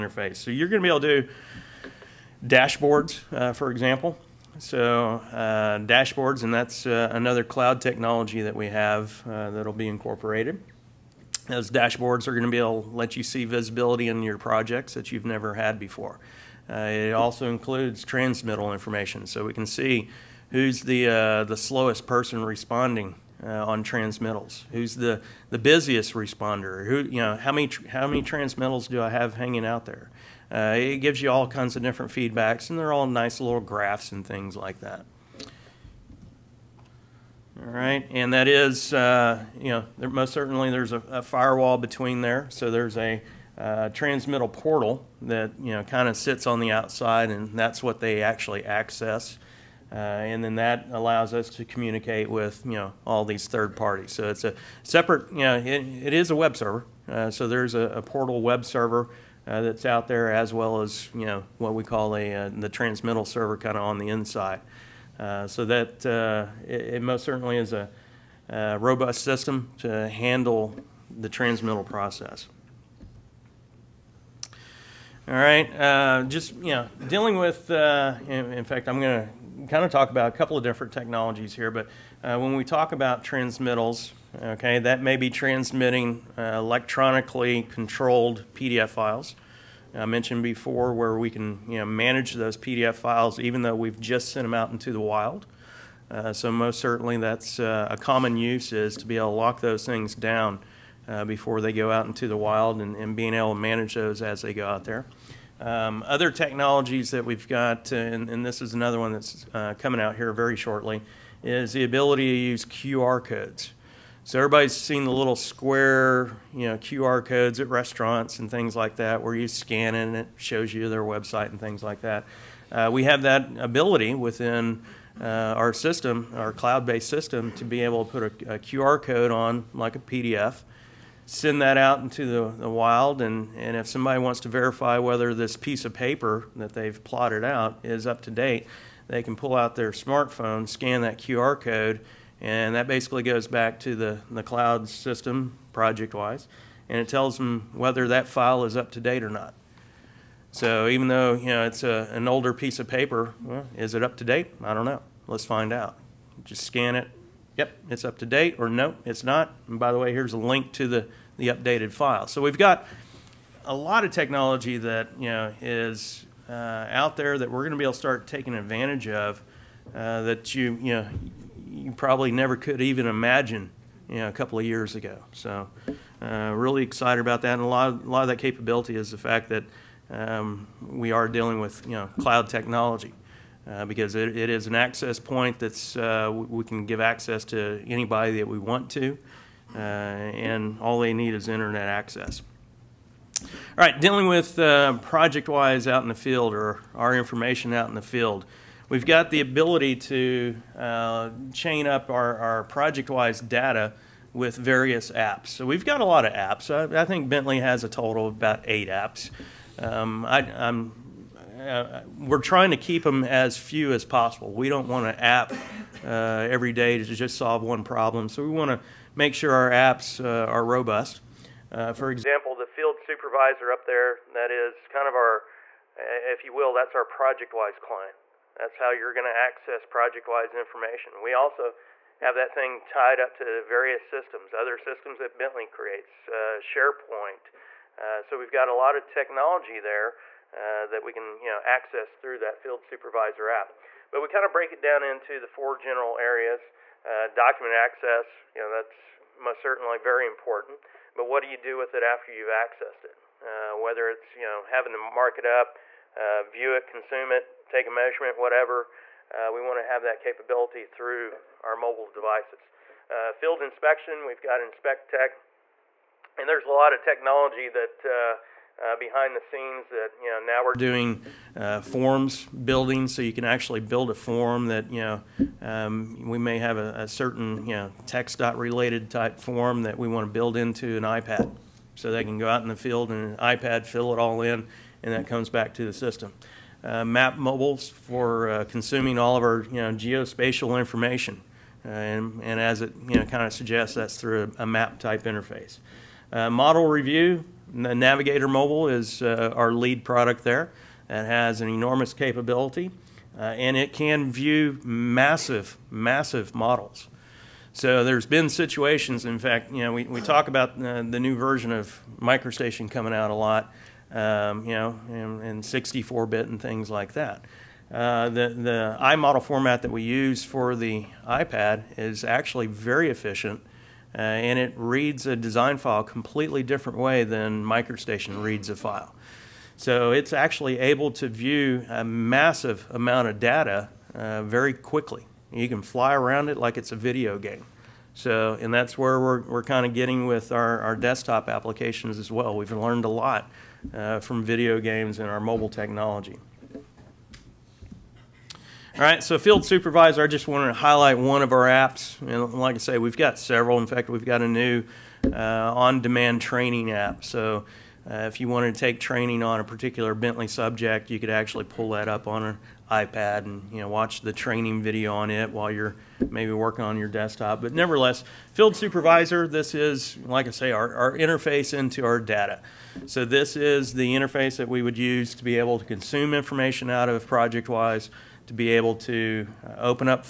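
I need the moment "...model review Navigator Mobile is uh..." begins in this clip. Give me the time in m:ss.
4:56.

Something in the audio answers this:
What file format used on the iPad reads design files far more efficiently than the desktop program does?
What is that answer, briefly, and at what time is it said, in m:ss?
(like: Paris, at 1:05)
iModel, at 5:19.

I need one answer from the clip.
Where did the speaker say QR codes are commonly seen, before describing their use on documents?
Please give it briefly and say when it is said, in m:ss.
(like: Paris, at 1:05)
restaurants, at 1:57.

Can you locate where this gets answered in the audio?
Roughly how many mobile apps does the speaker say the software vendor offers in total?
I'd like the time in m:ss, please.
3:28.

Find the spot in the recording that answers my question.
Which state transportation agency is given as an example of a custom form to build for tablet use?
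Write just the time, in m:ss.
4:38.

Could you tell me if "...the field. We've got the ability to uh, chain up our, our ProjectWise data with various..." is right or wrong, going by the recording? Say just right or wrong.
right.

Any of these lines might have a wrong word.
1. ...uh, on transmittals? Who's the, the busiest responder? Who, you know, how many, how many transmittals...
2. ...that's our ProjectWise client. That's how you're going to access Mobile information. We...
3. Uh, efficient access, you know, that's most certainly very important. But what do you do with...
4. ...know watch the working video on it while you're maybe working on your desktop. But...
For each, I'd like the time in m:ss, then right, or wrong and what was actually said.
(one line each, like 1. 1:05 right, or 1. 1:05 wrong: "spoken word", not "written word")
1. 0:23 right
2. 3:46 wrong: "ProjectWise", not "Mobile"
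3. 4:07 wrong: "document", not "efficient"
4. 6:03 wrong: "training", not "working".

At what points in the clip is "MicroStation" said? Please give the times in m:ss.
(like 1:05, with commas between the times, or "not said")
5:12, 5:27.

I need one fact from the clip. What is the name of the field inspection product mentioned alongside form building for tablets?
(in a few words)
InspectTech.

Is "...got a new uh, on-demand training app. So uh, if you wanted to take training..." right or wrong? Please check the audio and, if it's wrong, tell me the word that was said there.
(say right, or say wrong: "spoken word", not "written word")
right.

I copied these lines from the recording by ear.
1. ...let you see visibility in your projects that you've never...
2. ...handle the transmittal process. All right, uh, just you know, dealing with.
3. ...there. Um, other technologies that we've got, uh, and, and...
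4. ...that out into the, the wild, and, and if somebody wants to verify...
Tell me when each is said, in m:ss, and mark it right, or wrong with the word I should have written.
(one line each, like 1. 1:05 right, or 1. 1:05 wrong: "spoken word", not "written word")
1. 0:12 right
2. 1:10 right
3. 1:44 right
4. 2:11 right.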